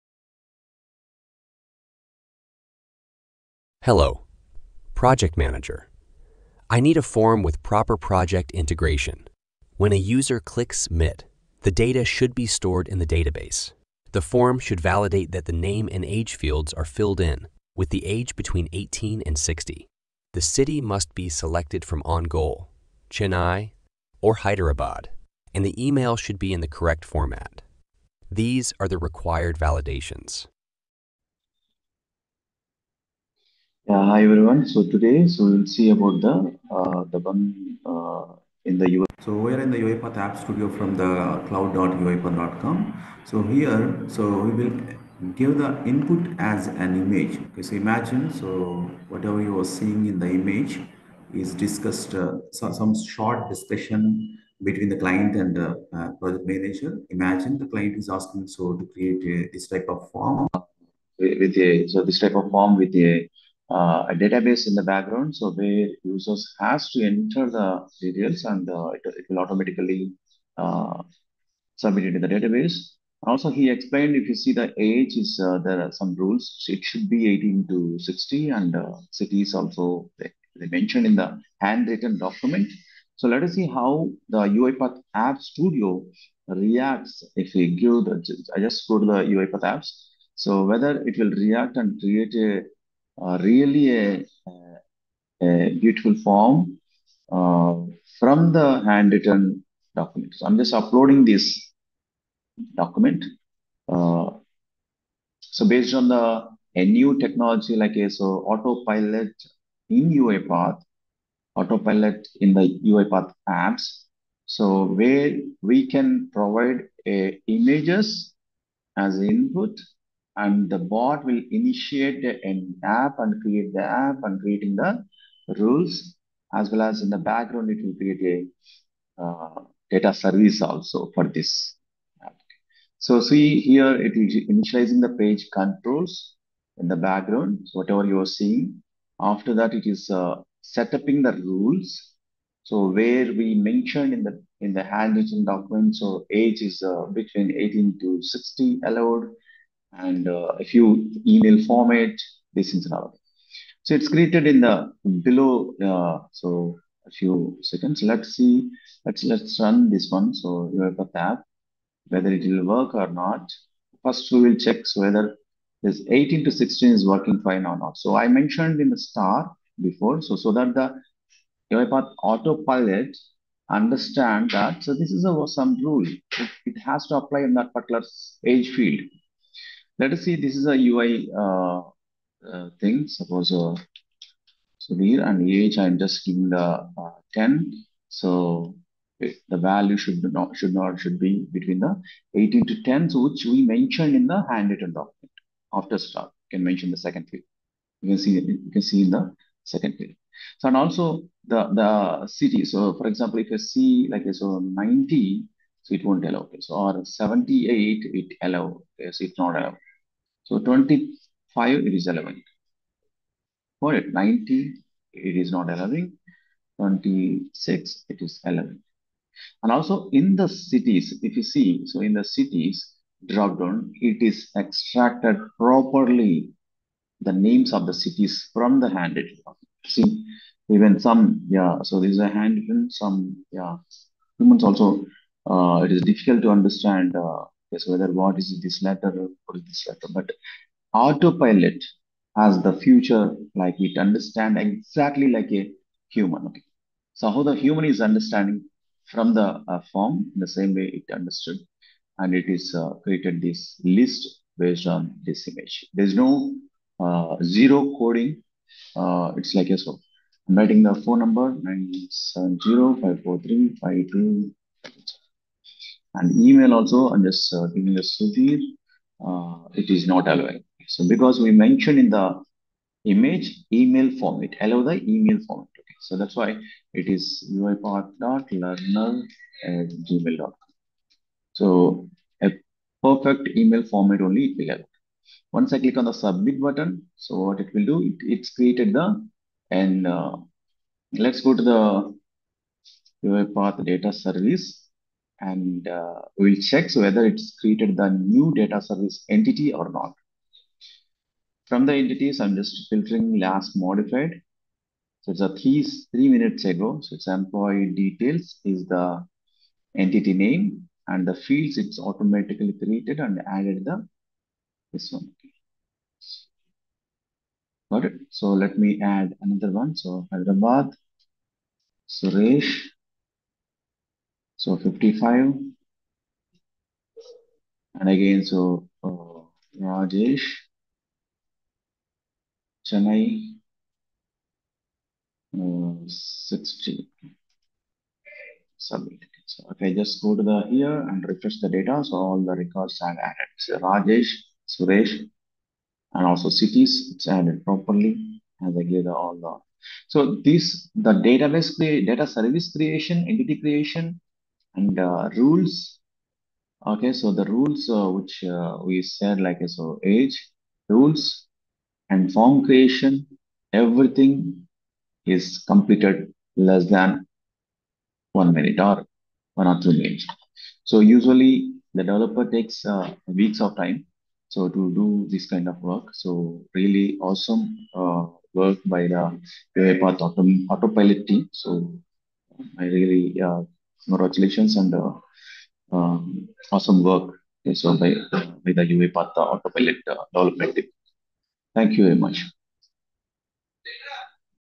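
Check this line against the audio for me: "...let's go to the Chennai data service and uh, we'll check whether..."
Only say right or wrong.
wrong.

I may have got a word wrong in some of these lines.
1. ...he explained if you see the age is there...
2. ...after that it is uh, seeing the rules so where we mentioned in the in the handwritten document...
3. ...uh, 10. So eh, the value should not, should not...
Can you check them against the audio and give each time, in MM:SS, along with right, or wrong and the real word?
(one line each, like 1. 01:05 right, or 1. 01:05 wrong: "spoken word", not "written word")
1. 01:13 right
2. 02:19 wrong: "setting", not "seeing"
3. 03:06 right.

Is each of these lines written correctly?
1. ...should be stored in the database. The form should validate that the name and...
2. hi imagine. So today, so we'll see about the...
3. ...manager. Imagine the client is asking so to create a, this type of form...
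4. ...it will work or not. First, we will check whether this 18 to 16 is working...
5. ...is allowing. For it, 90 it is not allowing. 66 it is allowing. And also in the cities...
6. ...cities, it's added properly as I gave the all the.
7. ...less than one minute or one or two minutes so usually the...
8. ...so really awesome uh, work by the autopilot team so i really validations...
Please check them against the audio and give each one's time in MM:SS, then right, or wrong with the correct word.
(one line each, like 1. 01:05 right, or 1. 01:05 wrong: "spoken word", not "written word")
1. 00:12 right
2. 00:33 wrong: "everyone", not "imagine"
3. 00:56 right
4. 02:42 right
5. 03:31 wrong: "26", not "66"
6. 05:46 right
7. 06:06 right
8. 06:16 wrong: "congratulations", not "validations".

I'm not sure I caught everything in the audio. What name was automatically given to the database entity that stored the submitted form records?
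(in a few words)
employee details.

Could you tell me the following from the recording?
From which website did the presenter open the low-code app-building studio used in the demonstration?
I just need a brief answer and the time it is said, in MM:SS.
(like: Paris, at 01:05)
cloud.uipath.com, at 00:41.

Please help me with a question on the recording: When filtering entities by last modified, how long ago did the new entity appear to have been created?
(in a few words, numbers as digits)
3 minutes ago.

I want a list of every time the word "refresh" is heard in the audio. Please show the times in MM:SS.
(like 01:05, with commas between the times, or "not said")
05:41.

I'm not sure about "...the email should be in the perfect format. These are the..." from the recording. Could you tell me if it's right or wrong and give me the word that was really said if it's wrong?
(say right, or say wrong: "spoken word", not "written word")
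wrong: "correct", not "perfect".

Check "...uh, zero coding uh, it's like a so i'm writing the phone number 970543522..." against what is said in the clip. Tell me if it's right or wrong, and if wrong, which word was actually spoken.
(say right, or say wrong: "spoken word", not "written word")
right.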